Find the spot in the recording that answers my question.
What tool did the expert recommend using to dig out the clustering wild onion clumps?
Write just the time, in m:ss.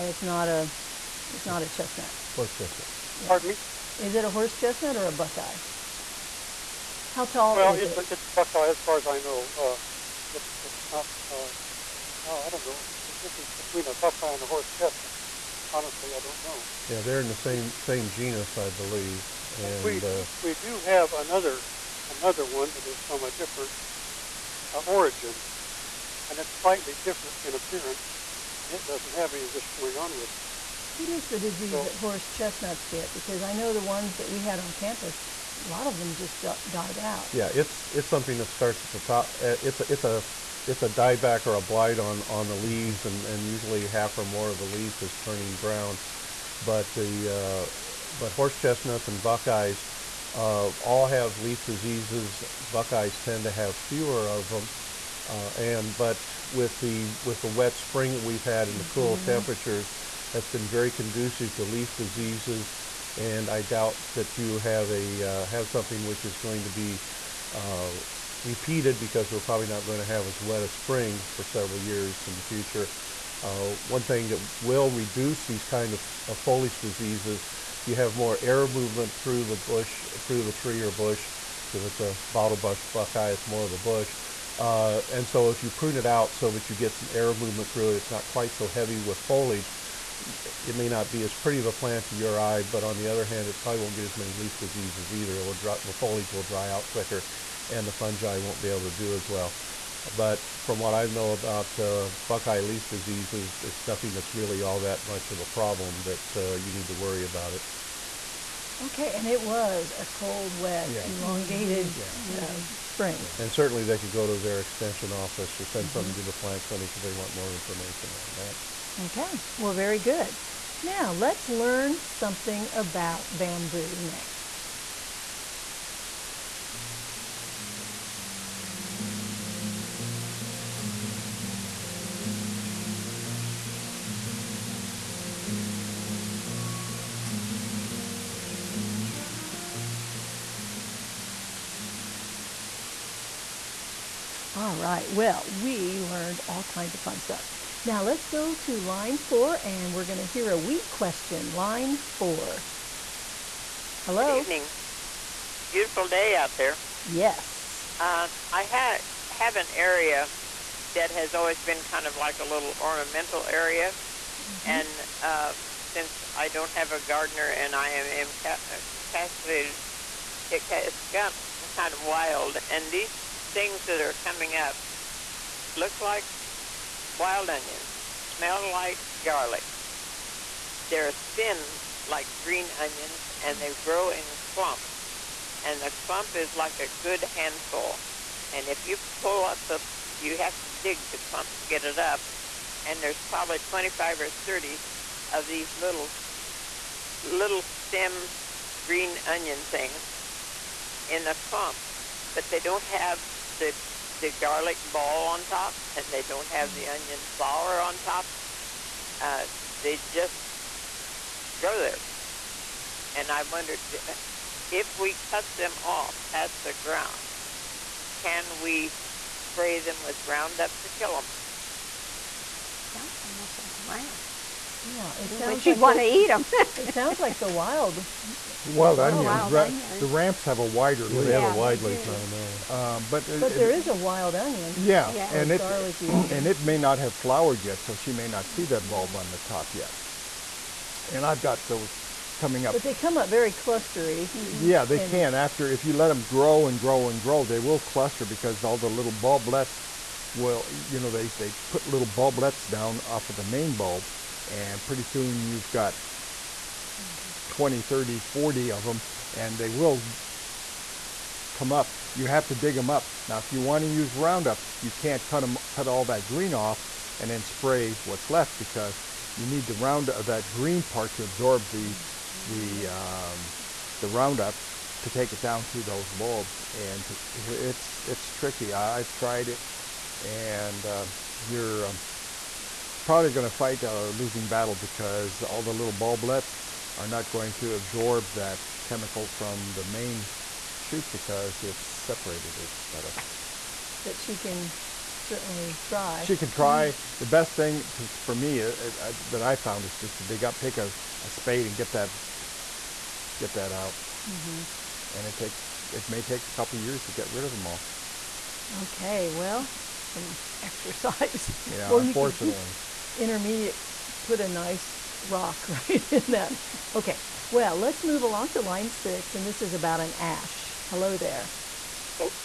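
5:01.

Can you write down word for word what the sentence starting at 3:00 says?
They're thin like green onions and they grow in clumps.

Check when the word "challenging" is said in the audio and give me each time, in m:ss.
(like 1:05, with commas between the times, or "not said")
not said.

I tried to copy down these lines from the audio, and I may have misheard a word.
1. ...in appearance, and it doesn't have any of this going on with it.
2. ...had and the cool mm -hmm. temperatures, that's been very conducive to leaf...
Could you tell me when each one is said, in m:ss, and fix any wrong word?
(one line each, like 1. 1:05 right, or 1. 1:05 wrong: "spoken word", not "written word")
1. 0:27 right
2. 0:58 right.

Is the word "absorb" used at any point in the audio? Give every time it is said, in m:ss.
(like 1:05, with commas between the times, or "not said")
4:31, 4:47.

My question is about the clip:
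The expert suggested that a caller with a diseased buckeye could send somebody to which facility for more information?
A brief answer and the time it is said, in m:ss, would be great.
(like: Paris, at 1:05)
The plant clinic, at 1:56.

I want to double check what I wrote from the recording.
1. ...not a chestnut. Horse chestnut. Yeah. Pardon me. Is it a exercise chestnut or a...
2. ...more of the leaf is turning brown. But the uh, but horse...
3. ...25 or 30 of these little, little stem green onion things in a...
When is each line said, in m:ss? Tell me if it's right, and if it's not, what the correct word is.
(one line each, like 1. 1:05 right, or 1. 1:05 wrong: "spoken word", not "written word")
1. 0:01 wrong: "horse", not "exercise"
2. 0:44 right
3. 3:13 right.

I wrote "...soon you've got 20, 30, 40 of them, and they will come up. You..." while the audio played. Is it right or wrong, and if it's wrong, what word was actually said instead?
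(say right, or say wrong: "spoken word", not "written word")
right.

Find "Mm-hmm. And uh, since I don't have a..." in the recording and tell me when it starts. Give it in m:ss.
2:44.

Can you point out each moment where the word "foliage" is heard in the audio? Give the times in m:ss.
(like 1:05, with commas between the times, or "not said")
1:16, 1:29, 1:35.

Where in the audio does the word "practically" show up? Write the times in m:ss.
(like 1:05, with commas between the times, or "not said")
not said.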